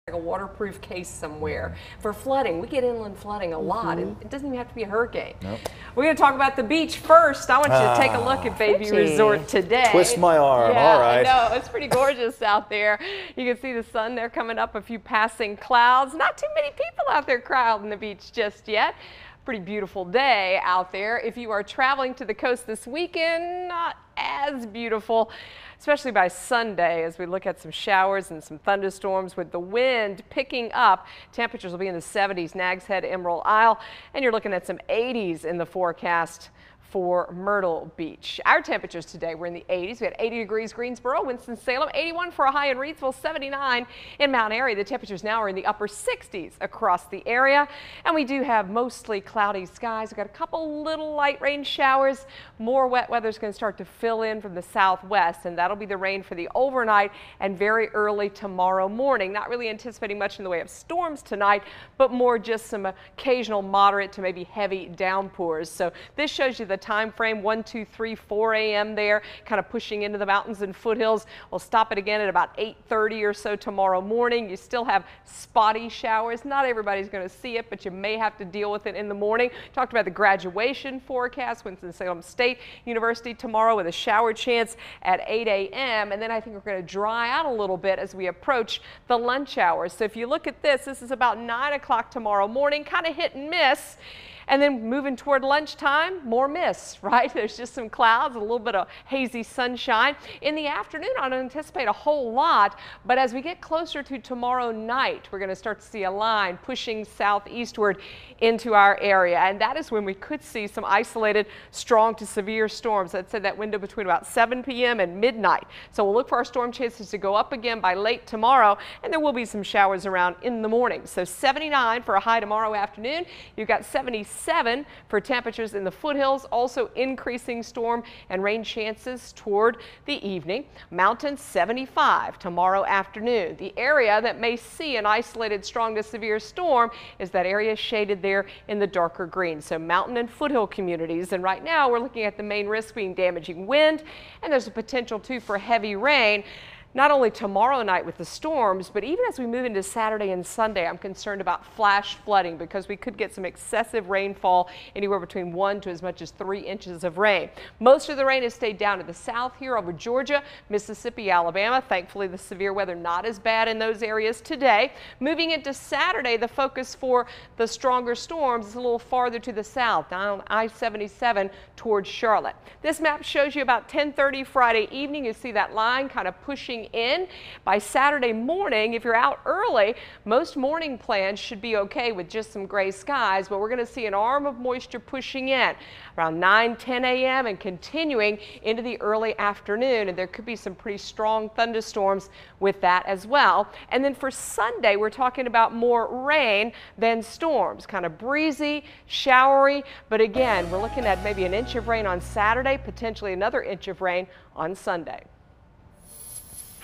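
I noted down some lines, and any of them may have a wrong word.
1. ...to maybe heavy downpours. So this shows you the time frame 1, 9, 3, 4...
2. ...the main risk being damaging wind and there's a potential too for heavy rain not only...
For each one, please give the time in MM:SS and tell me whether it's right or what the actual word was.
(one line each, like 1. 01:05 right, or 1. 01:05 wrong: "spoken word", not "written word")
1. 01:04 wrong: "2", not "9"
2. 02:22 right.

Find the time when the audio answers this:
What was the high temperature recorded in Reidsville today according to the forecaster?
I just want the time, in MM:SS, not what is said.
00:41.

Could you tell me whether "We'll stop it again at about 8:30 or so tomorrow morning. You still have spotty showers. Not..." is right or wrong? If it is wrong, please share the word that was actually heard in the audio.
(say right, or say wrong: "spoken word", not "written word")
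right.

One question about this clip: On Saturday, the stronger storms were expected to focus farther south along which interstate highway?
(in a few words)
I-77.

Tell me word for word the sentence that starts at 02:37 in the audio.
Most of the rain has stayed down to the south here over Georgia, Mississippi, Alabama.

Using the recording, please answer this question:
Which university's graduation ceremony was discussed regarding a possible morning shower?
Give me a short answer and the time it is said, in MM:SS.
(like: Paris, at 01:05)
Winston-Salem State University, at 01:21.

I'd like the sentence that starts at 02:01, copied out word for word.
So 79 for a high tomorrow afternoon.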